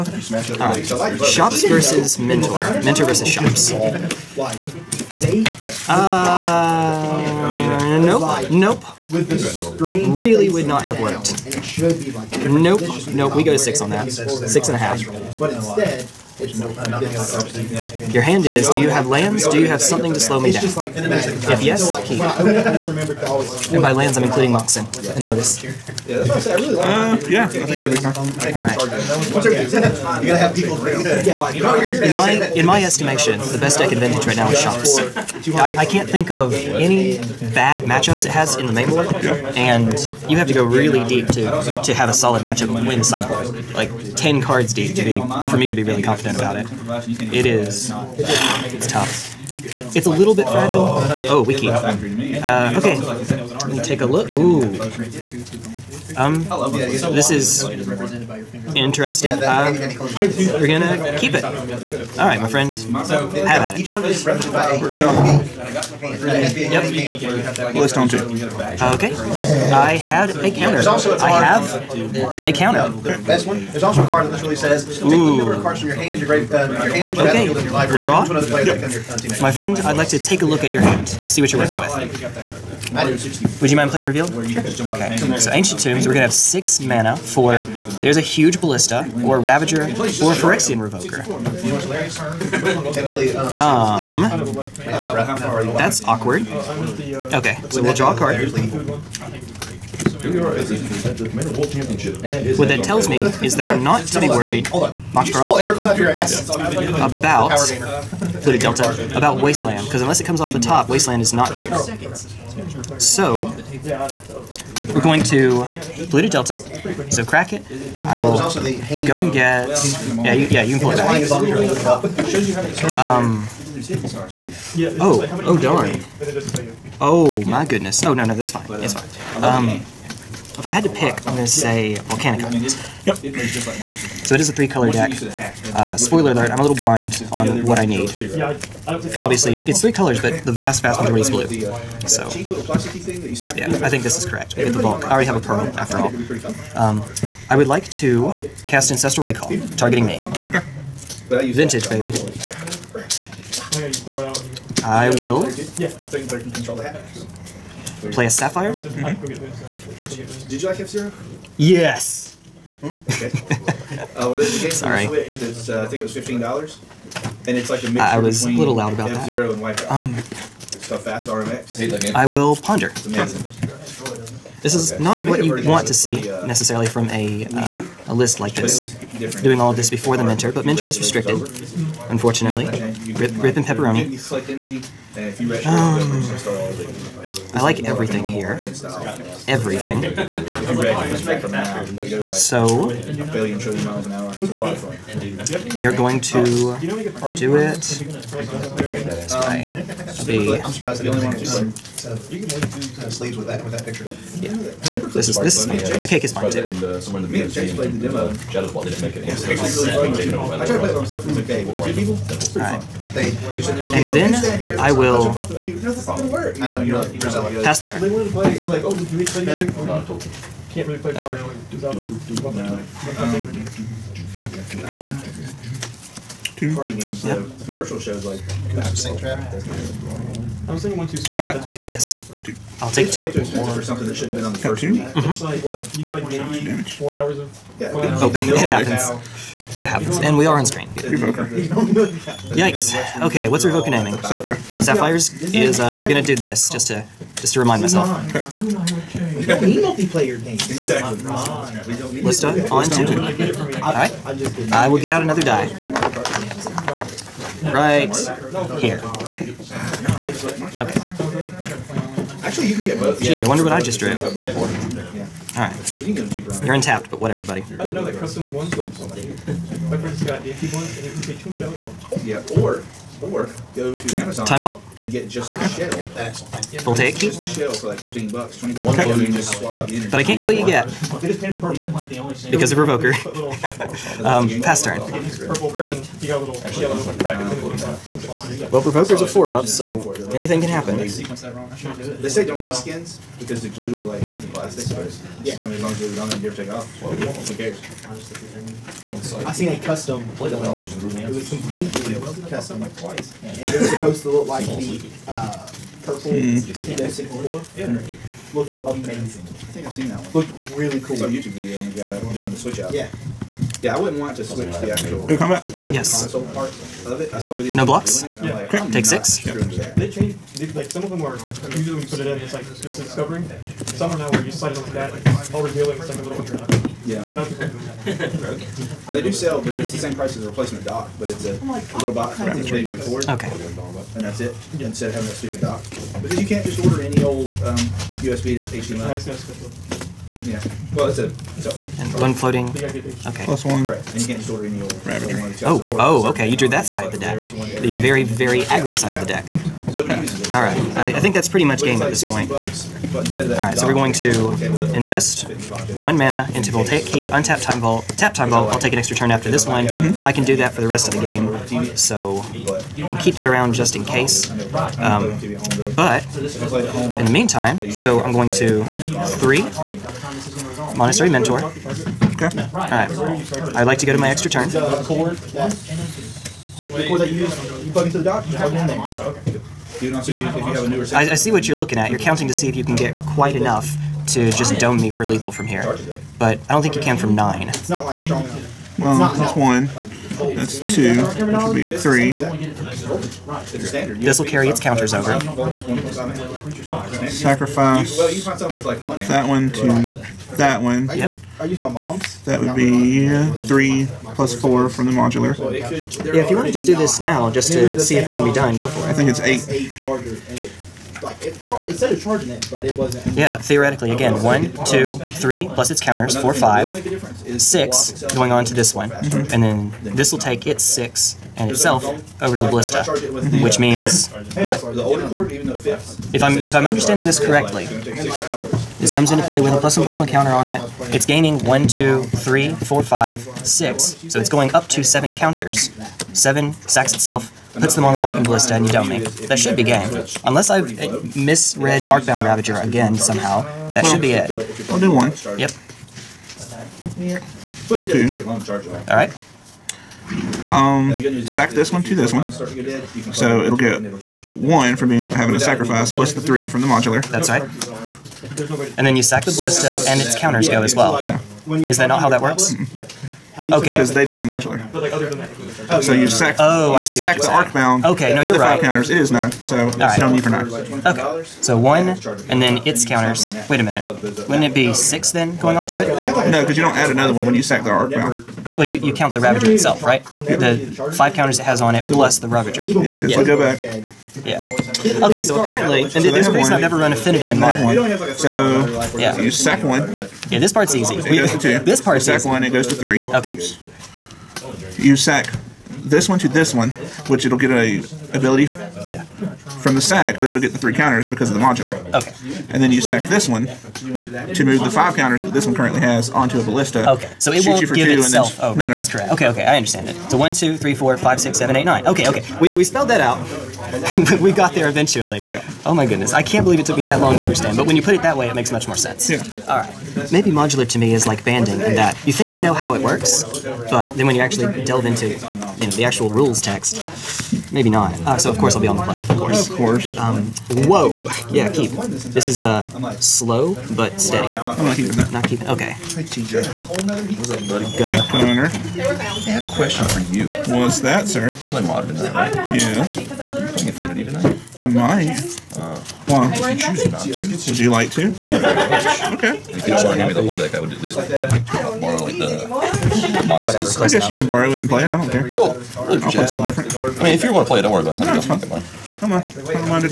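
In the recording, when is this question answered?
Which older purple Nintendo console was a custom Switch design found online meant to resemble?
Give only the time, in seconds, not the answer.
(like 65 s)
307 s.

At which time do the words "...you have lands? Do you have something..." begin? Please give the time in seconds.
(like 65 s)
18 s.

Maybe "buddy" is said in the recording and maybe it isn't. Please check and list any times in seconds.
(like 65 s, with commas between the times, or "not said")
267 s, 537 s.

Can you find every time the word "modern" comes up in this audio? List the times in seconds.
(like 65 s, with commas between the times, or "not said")
487 s, 541 s.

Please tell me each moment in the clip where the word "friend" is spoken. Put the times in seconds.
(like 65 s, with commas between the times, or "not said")
62 s, 79 s, 269 s.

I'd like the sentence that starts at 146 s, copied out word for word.
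Um, I would like to cast Ancestral Recall, targeting me.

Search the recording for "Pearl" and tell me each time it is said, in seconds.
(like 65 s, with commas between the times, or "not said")
105 s, 145 s.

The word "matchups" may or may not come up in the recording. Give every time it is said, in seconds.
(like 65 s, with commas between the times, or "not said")
37 s, 42 s.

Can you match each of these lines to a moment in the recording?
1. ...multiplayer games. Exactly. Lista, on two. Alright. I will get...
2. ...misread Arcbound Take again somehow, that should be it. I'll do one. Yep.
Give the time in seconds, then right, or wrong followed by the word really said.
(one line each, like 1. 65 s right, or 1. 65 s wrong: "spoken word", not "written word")
1. 249 s right
2. 441 s wrong: "Ravager", not "Take".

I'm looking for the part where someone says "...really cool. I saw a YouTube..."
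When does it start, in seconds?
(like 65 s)
310 s.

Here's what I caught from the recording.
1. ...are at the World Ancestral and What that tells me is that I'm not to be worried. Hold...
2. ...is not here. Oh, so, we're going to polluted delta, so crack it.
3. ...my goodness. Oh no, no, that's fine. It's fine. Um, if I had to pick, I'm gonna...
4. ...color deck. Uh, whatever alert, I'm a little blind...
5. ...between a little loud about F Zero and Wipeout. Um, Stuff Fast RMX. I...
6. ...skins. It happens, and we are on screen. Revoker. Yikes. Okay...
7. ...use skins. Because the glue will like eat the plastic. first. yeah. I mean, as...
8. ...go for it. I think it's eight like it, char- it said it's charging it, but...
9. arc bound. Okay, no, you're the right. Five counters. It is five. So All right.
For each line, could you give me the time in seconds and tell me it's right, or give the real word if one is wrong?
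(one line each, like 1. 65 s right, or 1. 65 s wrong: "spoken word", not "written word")
1. 100 s wrong: "Championship", not "Ancestral"
2. 111 s right
3. 127 s right
4. 134 s wrong: "spoiler", not "whatever"
5. 168 s right
6. 238 s wrong: "happens", not "skins"
7. 292 s right
8. 408 s right
9. 467 s wrong: "nine", not "five".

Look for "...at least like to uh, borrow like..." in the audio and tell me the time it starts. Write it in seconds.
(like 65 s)
550 s.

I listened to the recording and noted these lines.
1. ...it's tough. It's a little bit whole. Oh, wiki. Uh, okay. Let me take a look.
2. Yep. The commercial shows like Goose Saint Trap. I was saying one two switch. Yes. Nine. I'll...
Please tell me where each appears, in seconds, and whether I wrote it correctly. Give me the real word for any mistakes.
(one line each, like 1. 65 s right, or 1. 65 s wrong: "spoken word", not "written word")
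1. 48 s wrong: "fragile", not "whole"
2. 227 s wrong: "Two", not "Nine".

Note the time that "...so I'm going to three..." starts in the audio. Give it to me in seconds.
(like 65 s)
367 s.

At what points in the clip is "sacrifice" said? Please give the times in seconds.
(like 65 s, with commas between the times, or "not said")
397 s, 455 s.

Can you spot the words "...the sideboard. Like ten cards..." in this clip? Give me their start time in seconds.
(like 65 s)
42 s.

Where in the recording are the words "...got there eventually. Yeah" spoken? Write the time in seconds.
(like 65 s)
514 s.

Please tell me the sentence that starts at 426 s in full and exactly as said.
If I'm if I'm understanding this correctly, this comes into play with a plus one plus one counter on it.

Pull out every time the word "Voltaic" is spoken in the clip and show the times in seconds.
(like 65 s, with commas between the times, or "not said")
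356 s.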